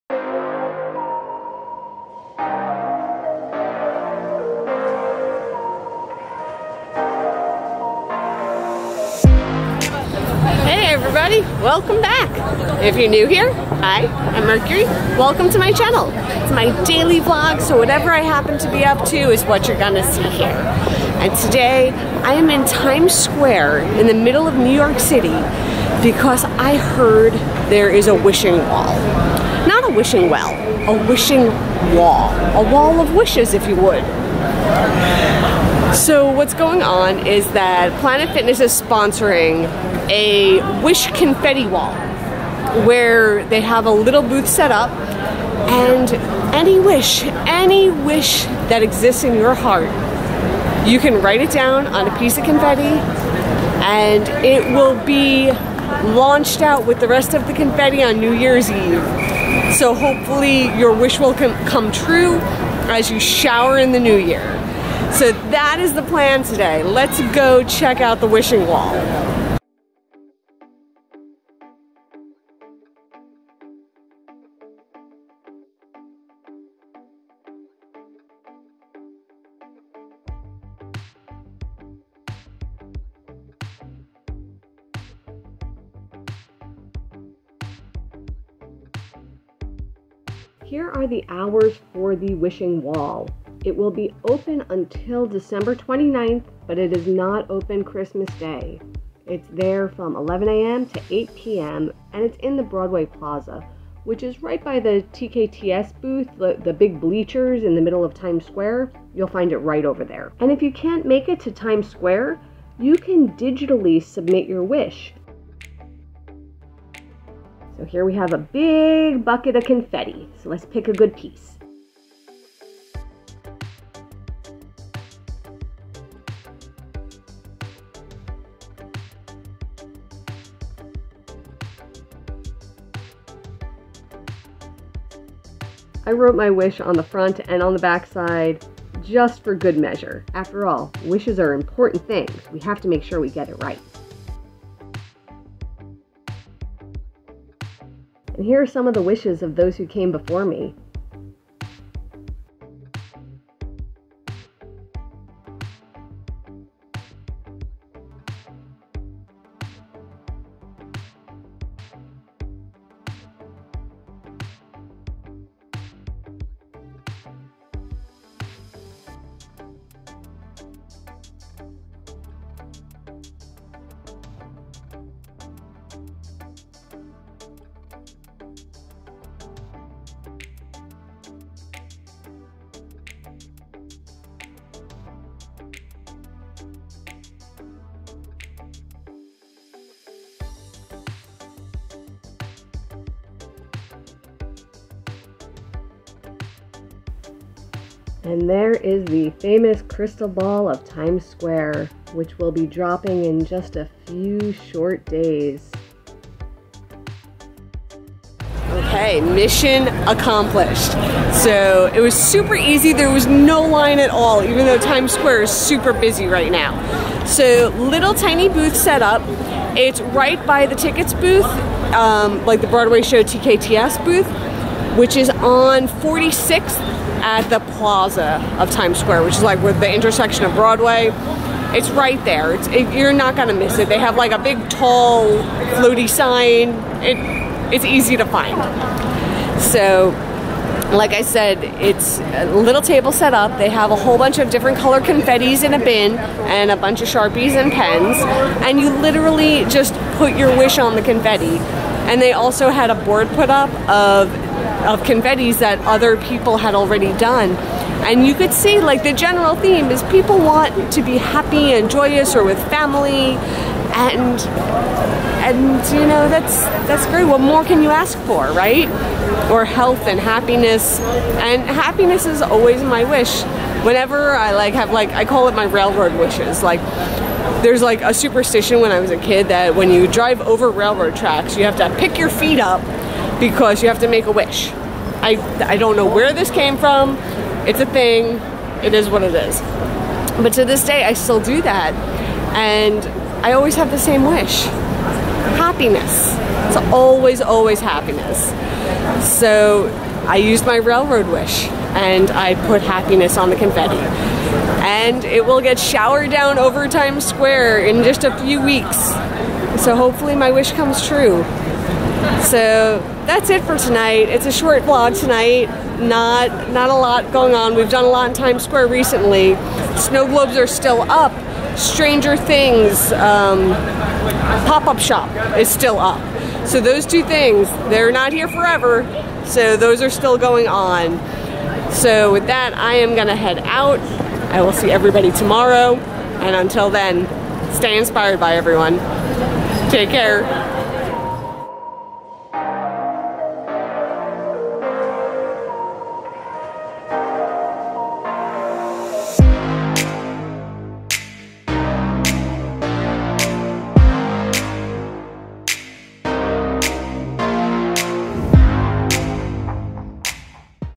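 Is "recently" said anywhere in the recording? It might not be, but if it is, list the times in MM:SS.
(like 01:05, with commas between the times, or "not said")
05:18.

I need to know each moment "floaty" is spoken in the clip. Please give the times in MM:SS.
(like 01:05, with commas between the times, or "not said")
03:55.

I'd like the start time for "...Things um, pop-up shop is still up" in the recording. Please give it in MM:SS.
05:22.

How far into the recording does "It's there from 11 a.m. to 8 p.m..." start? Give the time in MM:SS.
01:39.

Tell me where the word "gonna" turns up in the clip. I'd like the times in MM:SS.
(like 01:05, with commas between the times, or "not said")
00:19, 03:53, 05:33.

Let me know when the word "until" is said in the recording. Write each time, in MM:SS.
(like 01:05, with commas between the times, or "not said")
01:34, 05:36.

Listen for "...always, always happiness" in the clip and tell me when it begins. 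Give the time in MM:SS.
04:56.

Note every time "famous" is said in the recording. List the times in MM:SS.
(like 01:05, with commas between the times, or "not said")
03:19.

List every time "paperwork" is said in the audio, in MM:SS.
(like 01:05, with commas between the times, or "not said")
not said.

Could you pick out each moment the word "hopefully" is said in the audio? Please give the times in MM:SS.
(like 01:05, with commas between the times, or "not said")
00:59, 05:09.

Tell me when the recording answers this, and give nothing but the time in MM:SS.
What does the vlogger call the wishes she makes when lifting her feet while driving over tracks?
04:35.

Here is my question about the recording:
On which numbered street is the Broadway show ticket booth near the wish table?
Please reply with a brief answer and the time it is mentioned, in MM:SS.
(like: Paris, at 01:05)
46th, at 03:45.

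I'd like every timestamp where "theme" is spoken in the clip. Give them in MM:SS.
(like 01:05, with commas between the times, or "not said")
04:19.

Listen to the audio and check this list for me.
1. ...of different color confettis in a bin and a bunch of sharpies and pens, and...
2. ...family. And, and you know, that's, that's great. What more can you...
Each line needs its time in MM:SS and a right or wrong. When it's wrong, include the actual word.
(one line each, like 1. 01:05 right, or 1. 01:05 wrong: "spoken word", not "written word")
1. 04:04 right
2. 04:22 right.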